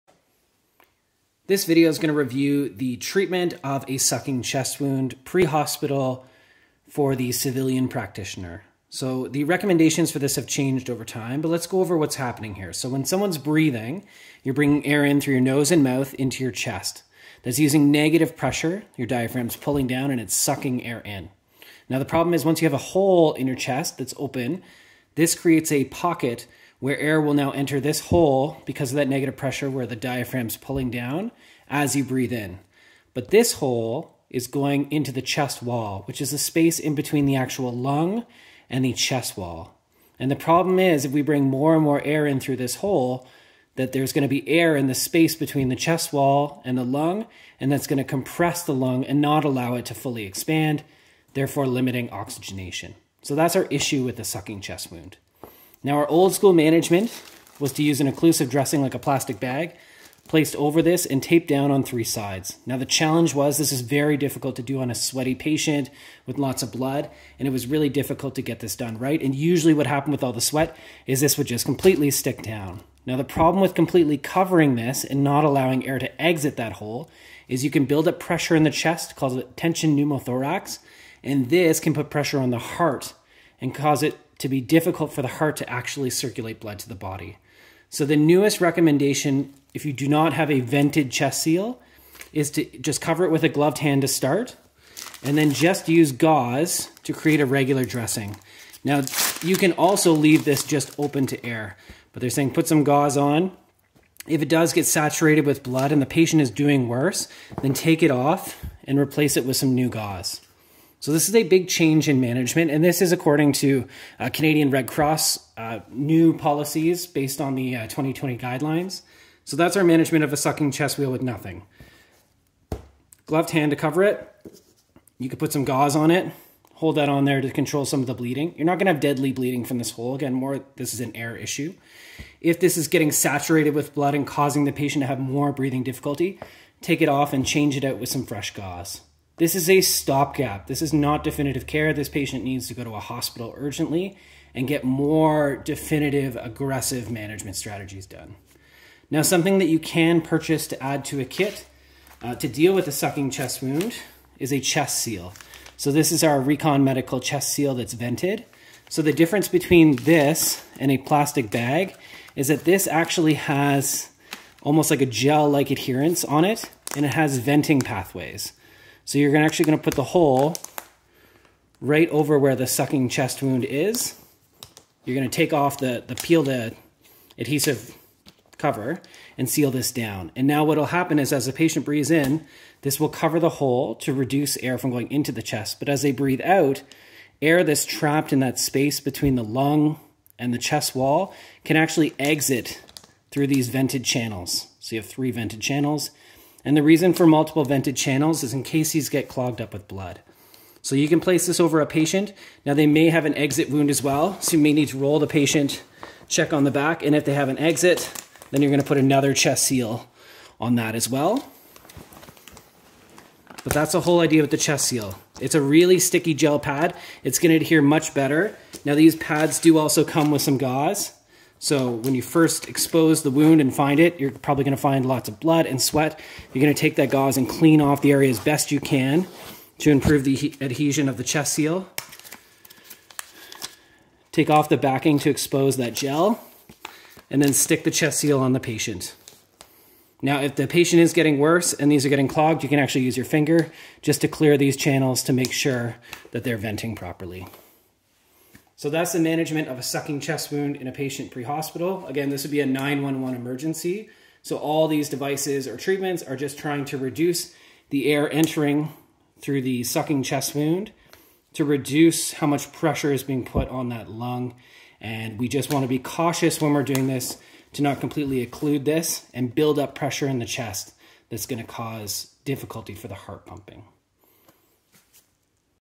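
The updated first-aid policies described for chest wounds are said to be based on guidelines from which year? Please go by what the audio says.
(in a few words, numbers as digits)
2020.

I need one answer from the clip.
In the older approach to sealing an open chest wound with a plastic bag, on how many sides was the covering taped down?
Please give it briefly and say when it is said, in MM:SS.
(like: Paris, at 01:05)
3, at 01:01.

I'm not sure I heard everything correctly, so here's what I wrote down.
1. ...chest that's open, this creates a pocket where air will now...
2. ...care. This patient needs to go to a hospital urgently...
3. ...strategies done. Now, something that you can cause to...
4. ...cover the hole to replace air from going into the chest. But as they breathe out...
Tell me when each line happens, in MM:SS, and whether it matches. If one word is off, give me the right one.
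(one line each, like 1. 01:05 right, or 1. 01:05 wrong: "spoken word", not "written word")
1. 00:23 right
2. 02:21 right
3. 02:27 wrong: "purchase", not "cause"
4. 03:03 wrong: "reduce", not "replace".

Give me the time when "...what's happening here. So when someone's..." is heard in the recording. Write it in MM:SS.
00:11.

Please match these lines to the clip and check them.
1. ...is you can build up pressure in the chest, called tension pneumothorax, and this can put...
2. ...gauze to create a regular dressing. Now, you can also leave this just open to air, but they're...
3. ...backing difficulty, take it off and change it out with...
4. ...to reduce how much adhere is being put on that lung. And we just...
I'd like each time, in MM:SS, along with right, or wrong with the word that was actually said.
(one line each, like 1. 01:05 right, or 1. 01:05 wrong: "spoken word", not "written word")
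1. 01:17 right
2. 01:36 right
3. 02:15 wrong: "breathing", not "backing"
4. 04:21 wrong: "pressure", not "adhere".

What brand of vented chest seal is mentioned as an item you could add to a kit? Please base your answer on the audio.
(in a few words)
Recon Medical.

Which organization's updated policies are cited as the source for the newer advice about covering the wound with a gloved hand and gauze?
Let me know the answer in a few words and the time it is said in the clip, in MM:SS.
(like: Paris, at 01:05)
Canadian Red Cross, at 01:54.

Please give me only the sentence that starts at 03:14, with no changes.
So you have three vented channels.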